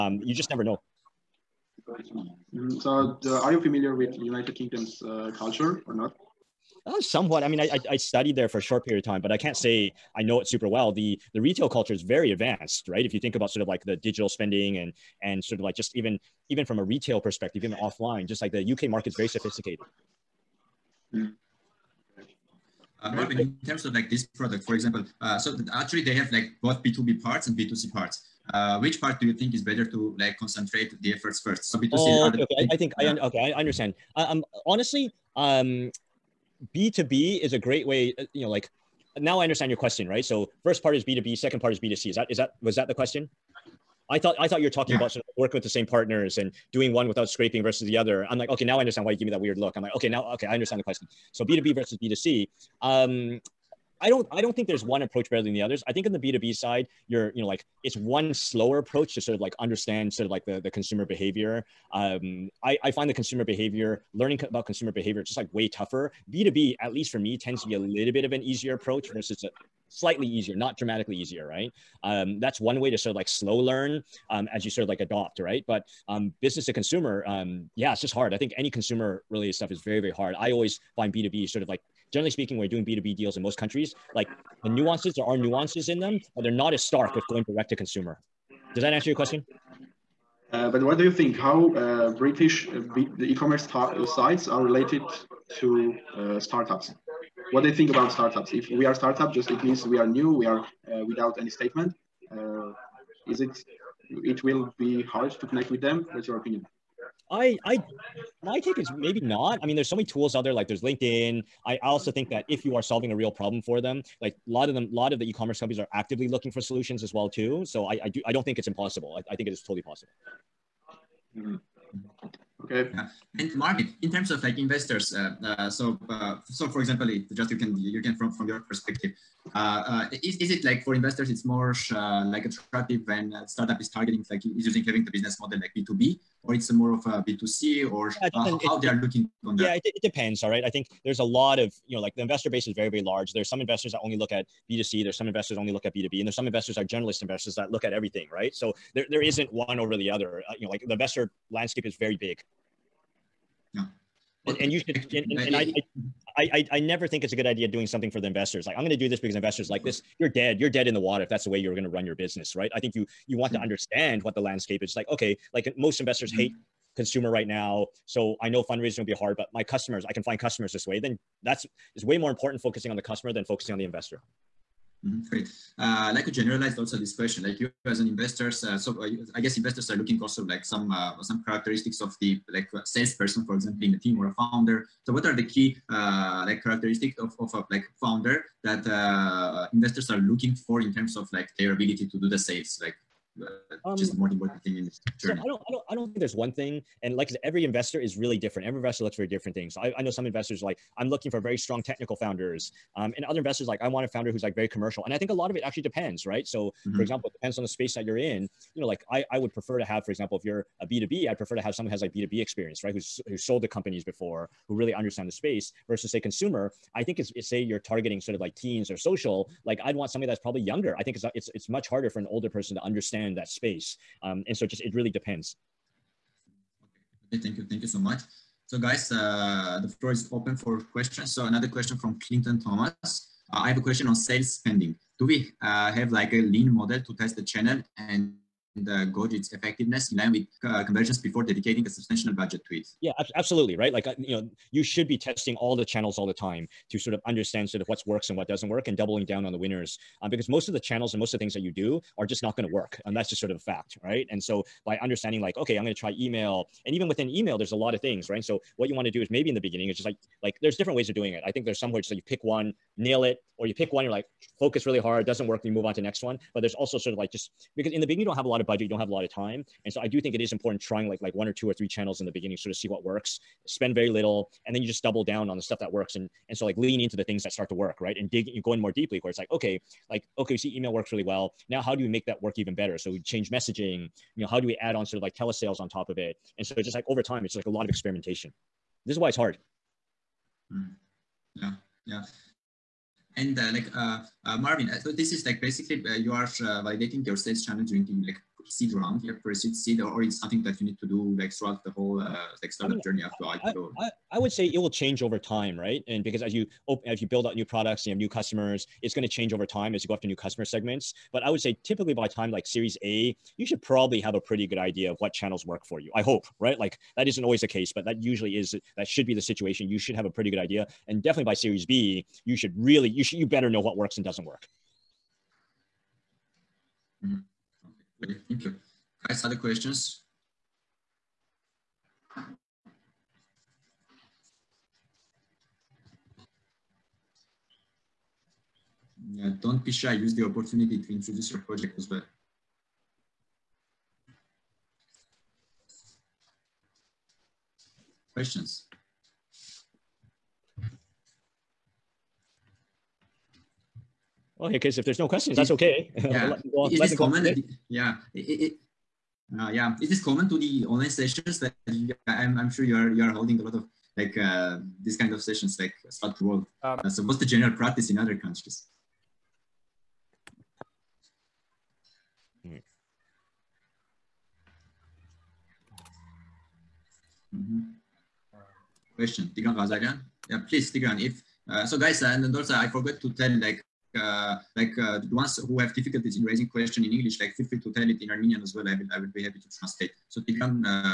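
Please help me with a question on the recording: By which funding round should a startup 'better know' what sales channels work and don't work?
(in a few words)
Series B.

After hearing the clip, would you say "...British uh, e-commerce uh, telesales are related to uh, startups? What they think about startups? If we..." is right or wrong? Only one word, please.
wrong.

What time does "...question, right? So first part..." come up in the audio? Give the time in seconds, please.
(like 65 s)
39 s.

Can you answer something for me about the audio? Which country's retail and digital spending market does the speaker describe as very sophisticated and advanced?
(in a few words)
United Kingdom.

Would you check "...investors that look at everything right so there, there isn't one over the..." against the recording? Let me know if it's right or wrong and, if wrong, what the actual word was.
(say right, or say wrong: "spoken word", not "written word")
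right.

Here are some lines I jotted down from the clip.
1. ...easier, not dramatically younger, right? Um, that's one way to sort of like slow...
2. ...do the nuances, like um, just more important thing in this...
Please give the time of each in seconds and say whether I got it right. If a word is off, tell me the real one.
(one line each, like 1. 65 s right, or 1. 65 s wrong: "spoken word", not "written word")
1. 70 s wrong: "easier", not "younger"
2. 192 s wrong: "sales", not "nuances".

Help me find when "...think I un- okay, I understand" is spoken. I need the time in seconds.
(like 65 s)
32 s.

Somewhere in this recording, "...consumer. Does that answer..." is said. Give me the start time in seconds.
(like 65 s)
87 s.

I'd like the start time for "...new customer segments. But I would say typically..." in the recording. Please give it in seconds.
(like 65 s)
310 s.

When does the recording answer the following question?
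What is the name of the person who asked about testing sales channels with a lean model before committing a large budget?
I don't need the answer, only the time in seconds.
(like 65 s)
232 s.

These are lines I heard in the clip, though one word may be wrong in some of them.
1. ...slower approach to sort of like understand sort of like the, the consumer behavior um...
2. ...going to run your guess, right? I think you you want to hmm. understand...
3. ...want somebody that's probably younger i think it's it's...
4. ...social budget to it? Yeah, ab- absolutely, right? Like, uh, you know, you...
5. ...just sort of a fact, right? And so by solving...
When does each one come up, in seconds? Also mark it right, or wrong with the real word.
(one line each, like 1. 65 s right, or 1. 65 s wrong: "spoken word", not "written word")
1. 58 s right
2. 161 s wrong: "business", not "guess"
3. 219 s right
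4. 241 s wrong: "substantial", not "social"
5. 253 s wrong: "understanding", not "solving".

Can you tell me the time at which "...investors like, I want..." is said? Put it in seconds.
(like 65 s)
203 s.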